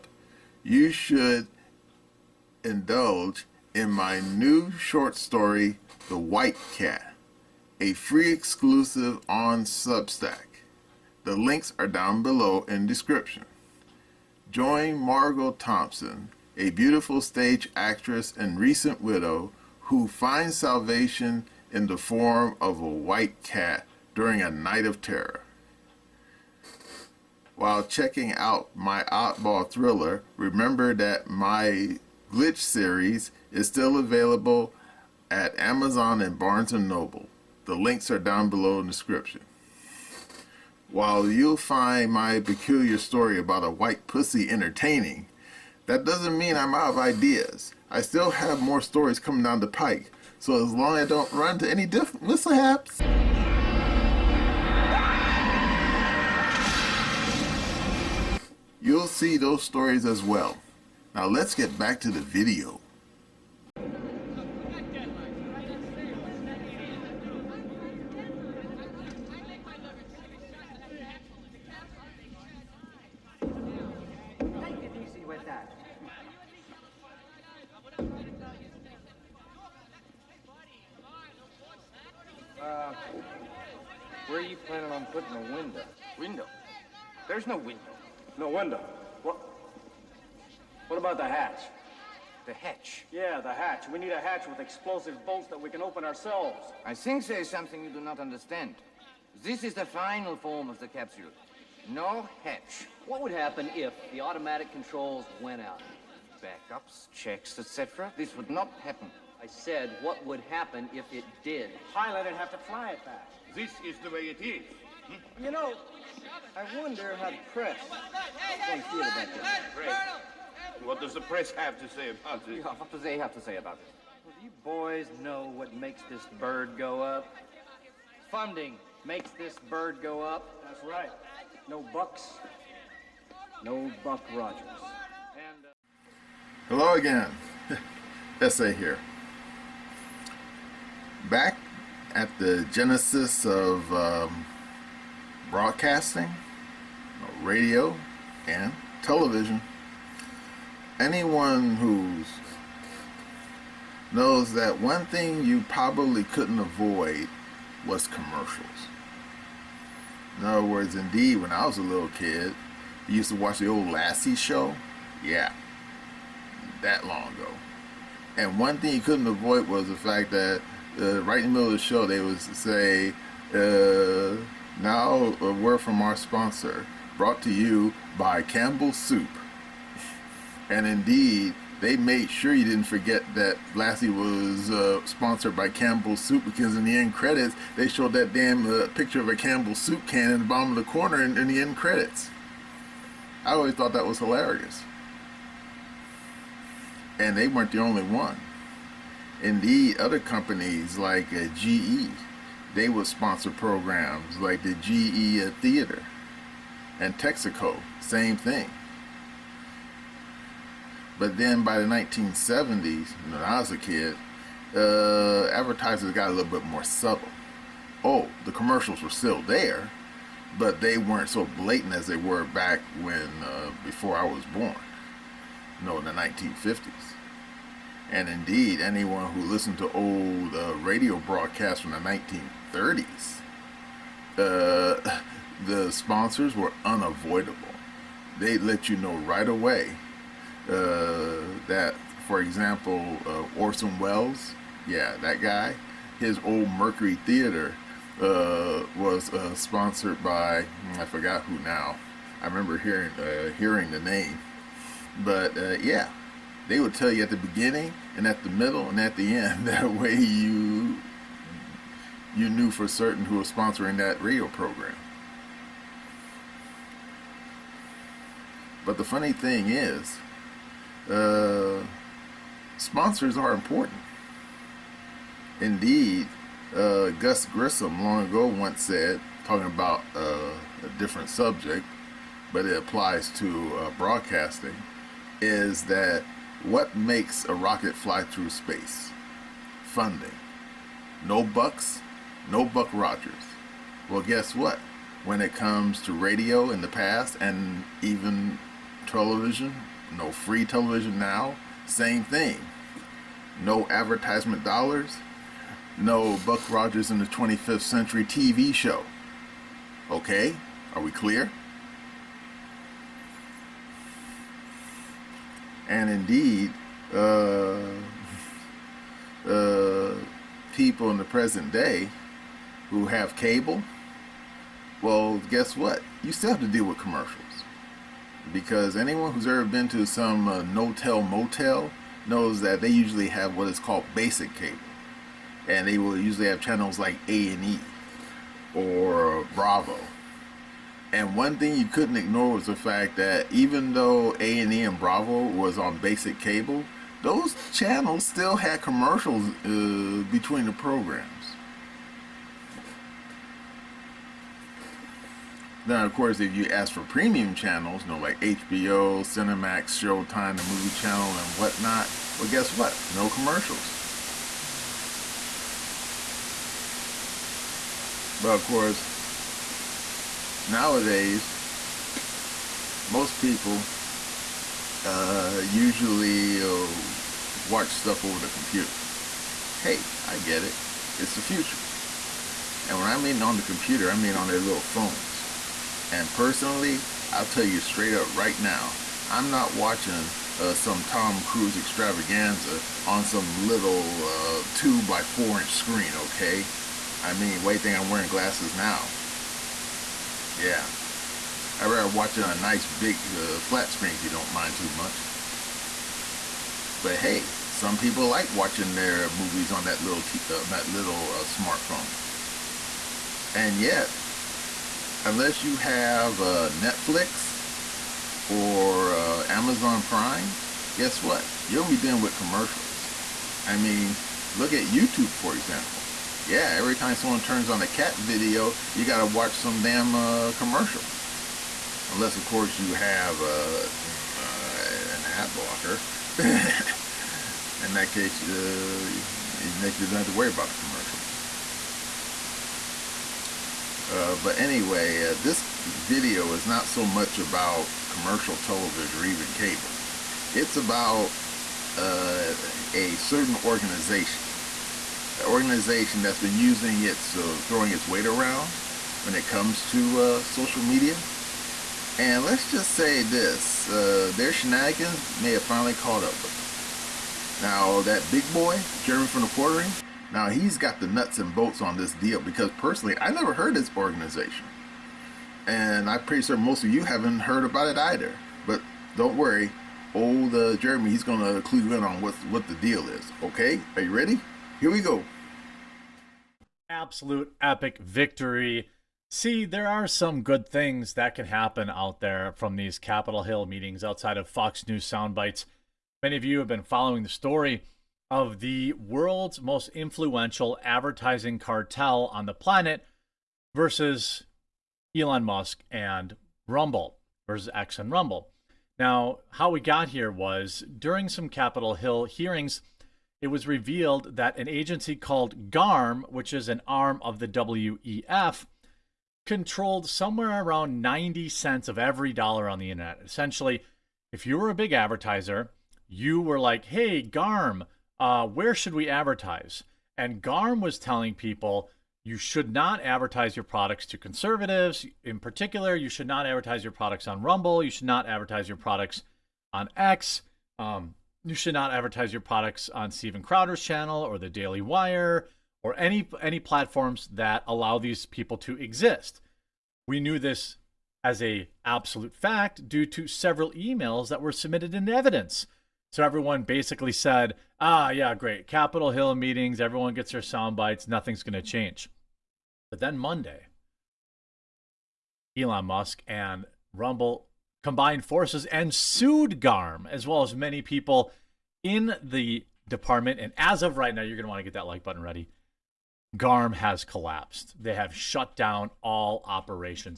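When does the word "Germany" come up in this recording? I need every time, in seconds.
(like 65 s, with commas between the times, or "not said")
not said.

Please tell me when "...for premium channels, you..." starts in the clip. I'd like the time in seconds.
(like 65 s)
356 s.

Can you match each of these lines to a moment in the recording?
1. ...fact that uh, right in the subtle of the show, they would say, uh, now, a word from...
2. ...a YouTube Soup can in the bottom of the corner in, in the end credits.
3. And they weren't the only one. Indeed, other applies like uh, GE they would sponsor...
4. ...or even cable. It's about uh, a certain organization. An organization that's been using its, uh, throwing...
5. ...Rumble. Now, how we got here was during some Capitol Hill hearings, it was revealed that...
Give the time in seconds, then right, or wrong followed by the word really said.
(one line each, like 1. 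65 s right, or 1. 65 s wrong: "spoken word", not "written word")
1. 169 s wrong: "middle", not "subtle"
2. 189 s wrong: "Campbell", not "YouTube"
3. 197 s wrong: "companies", not "applies"
4. 449 s right
5. 508 s right.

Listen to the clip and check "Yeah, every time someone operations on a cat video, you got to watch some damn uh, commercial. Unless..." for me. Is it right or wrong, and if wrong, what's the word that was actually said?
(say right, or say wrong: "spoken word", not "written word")
wrong: "turns", not "operations".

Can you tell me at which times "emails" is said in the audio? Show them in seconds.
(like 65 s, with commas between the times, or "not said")
553 s.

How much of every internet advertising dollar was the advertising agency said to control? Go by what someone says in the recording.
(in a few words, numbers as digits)
90 cents.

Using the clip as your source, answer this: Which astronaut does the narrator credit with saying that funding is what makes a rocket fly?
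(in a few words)
Gus Grissom.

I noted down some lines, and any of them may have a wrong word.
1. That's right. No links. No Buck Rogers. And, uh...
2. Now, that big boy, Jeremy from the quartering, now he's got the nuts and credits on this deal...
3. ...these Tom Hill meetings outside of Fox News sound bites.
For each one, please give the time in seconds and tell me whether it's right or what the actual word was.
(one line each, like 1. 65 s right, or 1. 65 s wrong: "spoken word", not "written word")
1. 130 s wrong: "bucks", not "links"
2. 467 s wrong: "bolts", not "credits"
3. 492 s wrong: "Capitol", not "Tom".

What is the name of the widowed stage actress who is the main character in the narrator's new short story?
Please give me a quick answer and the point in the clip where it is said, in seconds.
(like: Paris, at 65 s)
Margot Thompson, at 14 s.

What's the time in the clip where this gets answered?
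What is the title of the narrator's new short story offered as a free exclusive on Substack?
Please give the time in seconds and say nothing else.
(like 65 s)
6 s.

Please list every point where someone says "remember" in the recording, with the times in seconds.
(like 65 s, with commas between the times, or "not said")
30 s, 252 s.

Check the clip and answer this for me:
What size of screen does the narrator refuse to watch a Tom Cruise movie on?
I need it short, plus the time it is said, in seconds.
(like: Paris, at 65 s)
2 by 4 inch, at 394 s.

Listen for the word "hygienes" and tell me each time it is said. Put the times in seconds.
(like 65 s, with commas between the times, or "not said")
not said.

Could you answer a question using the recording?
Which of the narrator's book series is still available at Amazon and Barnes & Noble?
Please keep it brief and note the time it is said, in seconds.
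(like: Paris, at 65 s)
Glitch, at 32 s.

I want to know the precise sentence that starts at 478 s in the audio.
But don't worry, old uh, Jeremy, he's gonna clue you in on what what the deal is.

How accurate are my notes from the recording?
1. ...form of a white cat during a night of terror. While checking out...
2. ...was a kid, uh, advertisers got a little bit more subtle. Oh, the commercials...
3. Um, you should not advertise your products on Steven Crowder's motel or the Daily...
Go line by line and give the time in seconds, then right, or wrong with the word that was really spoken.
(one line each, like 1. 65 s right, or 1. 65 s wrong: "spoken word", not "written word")
1. 21 s right
2. 213 s right
3. 540 s wrong: "channel", not "motel".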